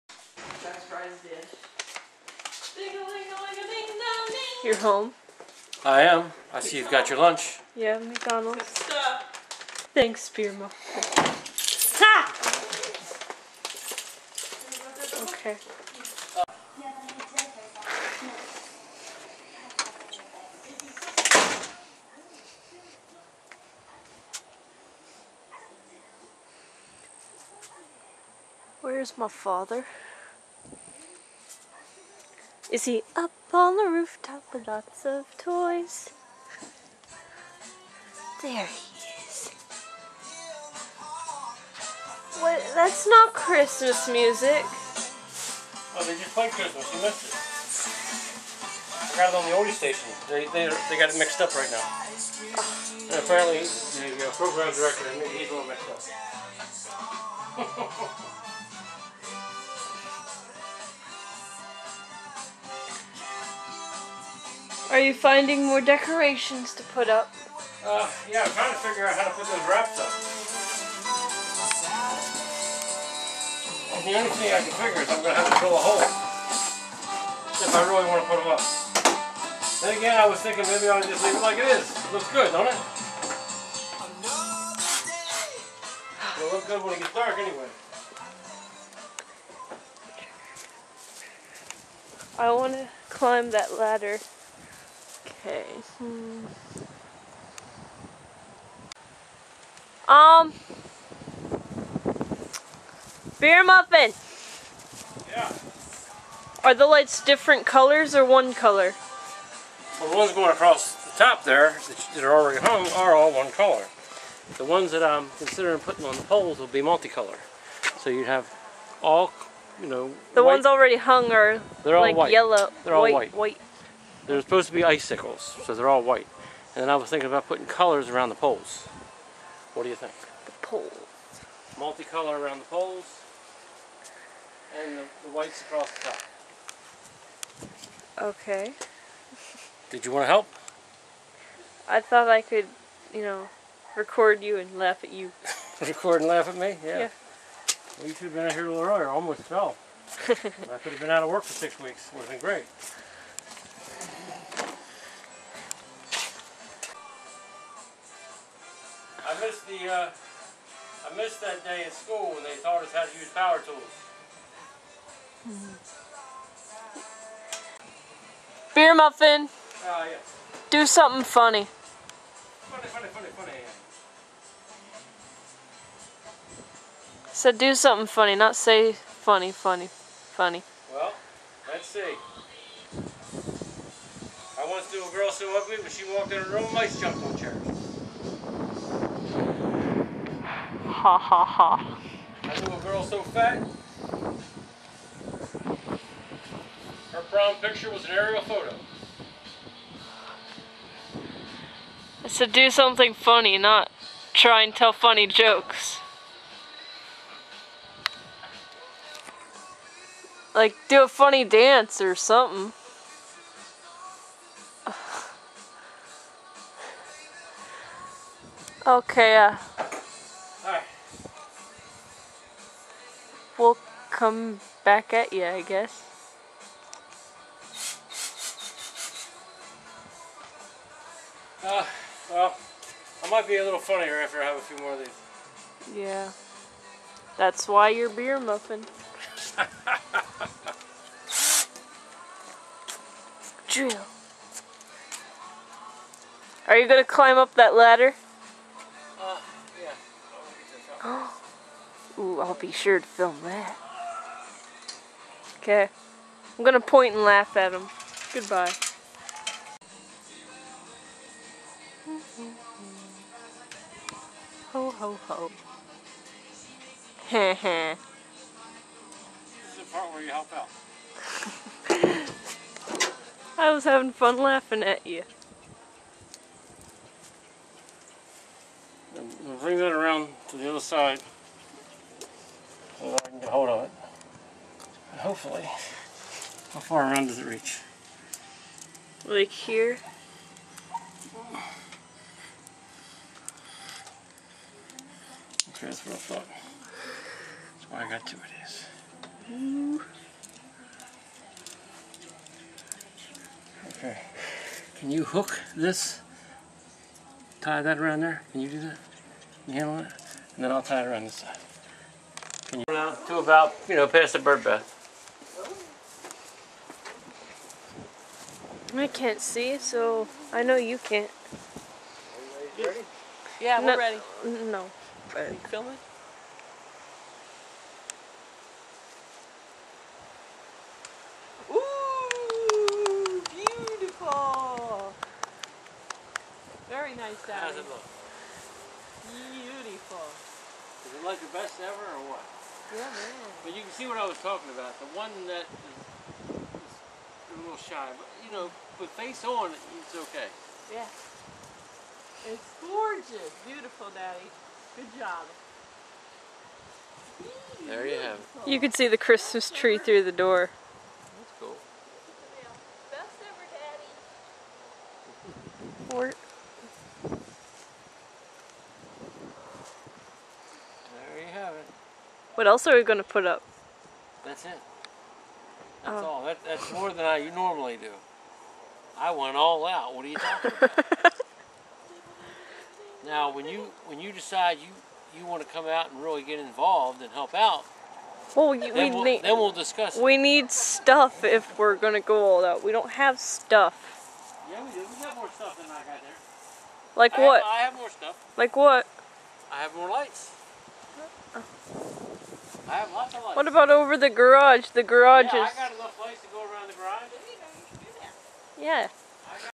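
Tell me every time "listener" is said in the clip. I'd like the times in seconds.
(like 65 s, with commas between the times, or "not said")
not said.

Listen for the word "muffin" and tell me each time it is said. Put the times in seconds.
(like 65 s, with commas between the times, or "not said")
103 s, 168 s, 238 s.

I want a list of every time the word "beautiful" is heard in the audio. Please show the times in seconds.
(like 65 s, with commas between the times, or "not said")
333 s, 339 s, 353 s.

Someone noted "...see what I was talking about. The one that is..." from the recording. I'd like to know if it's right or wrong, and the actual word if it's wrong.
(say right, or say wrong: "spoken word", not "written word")
right.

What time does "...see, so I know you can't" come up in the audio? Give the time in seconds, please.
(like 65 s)
319 s.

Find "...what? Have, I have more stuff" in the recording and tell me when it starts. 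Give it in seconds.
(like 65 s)
397 s.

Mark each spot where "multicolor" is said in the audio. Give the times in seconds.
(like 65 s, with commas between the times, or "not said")
116 s, 131 s.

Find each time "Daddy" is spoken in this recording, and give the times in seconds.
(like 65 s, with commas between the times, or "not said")
337 s, 354 s, 363 s.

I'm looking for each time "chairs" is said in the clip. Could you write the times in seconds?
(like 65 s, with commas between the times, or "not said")
187 s.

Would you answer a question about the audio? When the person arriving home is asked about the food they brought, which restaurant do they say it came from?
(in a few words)
McDonald's.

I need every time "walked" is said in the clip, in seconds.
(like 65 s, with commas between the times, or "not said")
186 s.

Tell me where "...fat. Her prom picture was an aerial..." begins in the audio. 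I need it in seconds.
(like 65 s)
193 s.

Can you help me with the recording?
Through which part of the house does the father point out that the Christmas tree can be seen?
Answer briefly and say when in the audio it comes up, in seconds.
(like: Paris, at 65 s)
The door, at 360 s.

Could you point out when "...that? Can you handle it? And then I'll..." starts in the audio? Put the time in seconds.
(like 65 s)
308 s.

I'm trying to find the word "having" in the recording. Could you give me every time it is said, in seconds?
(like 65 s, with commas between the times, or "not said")
273 s.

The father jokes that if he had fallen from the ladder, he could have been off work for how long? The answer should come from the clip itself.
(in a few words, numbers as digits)
6 weeks.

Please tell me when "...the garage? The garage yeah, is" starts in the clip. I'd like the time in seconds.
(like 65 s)
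404 s.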